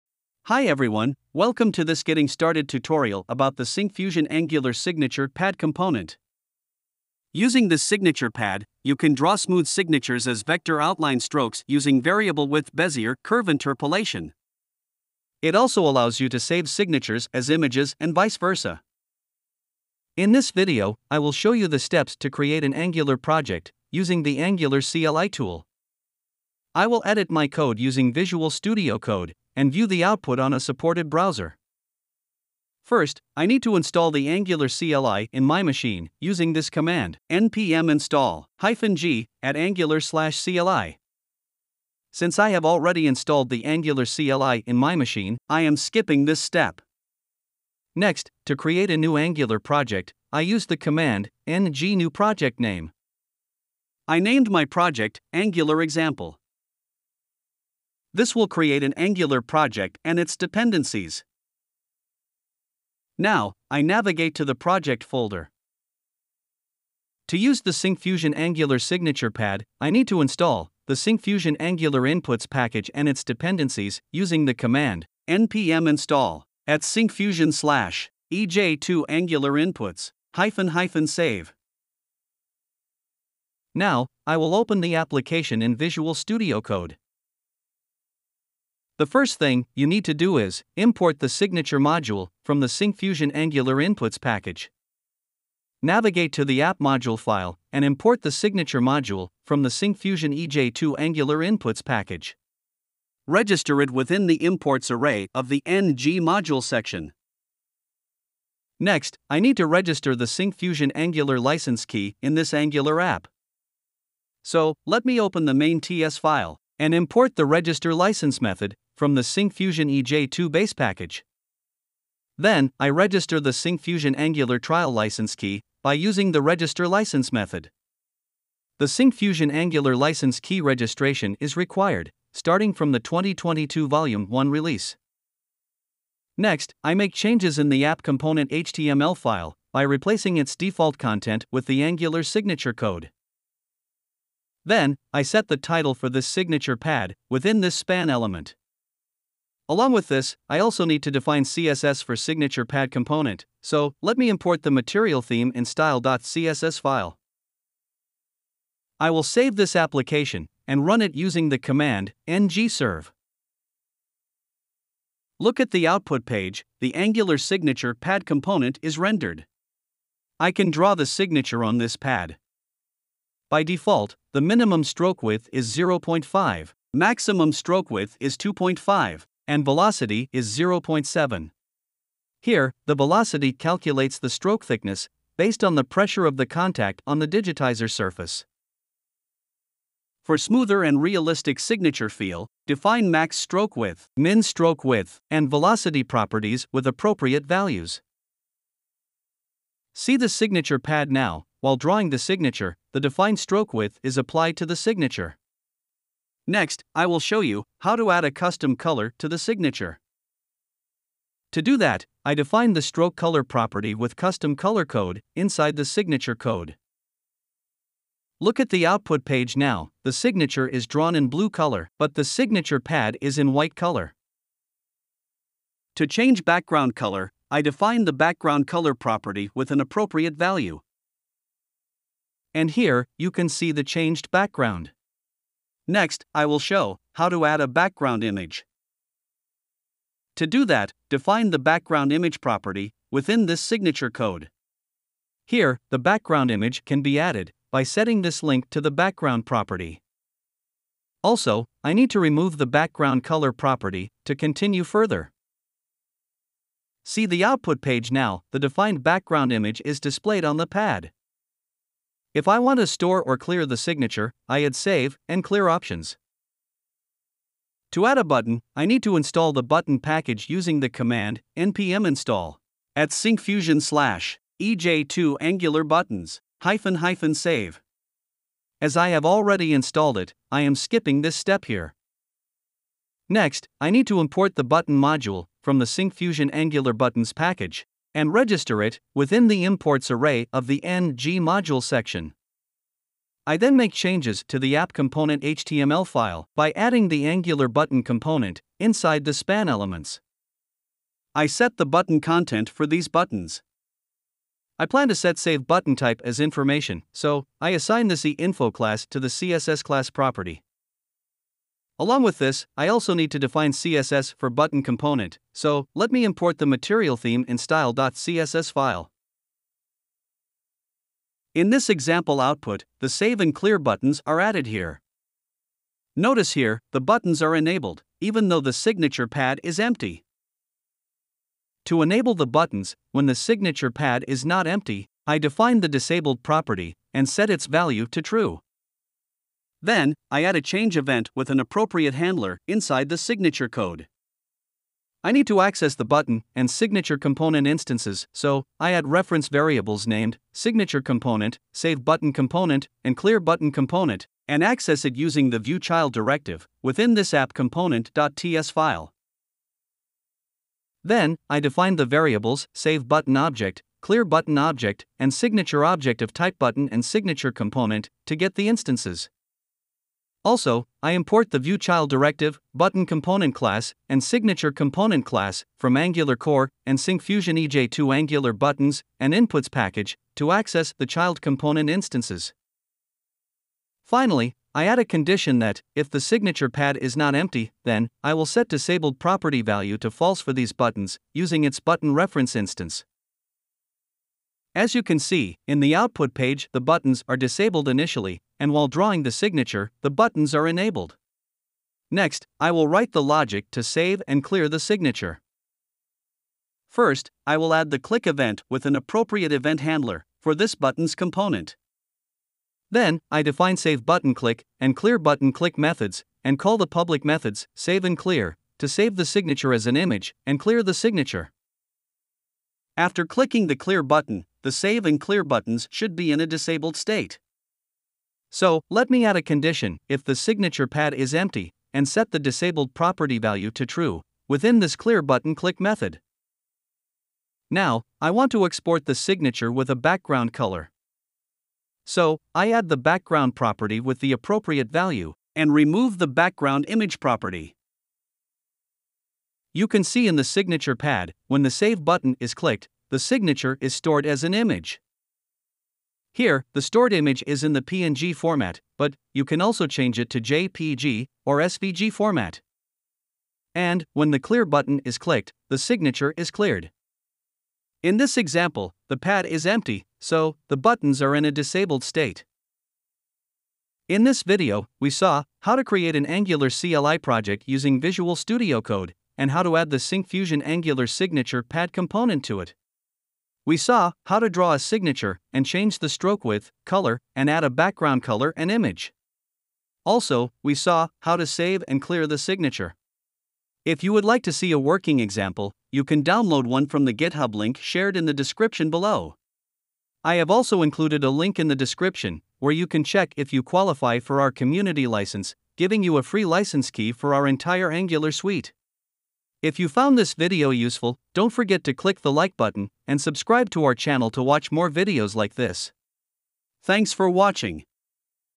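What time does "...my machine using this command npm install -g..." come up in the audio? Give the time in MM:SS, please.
00:35.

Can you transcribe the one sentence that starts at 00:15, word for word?
It also allows you to save signatures as images and vice versa.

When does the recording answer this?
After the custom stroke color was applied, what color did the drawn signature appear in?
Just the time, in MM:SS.
03:41.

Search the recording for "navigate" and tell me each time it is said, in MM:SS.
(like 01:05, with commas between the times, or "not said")
01:03, 01:35.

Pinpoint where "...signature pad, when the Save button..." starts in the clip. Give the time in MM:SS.
07:30.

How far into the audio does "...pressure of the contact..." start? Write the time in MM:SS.
03:05.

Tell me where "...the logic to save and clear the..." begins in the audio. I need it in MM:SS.
06:43.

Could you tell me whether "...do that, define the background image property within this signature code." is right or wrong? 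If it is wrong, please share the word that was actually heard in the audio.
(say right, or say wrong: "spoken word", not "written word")
right.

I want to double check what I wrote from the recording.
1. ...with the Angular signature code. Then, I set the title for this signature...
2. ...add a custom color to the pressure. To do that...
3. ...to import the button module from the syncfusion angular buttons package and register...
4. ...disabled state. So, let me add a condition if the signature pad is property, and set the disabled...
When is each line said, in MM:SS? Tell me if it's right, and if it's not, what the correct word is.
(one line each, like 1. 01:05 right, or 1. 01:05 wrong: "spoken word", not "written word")
1. 02:21 right
2. 03:28 wrong: "signature", not "pressure"
3. 04:44 right
4. 07:06 wrong: "empty", not "property".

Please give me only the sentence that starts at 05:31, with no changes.
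To enable the buttons, when the signature pad is not empty, I define the disabled property and set its value to true.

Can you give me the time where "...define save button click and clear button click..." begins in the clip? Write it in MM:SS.
06:53.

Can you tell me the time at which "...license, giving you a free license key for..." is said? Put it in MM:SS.
08:25.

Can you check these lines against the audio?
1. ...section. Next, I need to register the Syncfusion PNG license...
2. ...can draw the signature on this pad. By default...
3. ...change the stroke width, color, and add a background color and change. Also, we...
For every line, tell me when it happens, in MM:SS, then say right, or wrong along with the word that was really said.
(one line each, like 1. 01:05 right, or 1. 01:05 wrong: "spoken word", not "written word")
1. 01:46 wrong: "Angular", not "PNG"
2. 02:50 right
3. 08:05 wrong: "image", not "change".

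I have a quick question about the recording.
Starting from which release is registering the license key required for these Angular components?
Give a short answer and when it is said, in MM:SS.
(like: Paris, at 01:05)
2022 Volume 1, at 02:12.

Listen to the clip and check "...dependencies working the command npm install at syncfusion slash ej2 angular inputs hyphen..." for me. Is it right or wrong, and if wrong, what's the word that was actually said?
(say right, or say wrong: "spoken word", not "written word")
wrong: "using", not "working".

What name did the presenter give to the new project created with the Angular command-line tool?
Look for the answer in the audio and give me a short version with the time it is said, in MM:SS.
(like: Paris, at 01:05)
Angular Example, at 00:55.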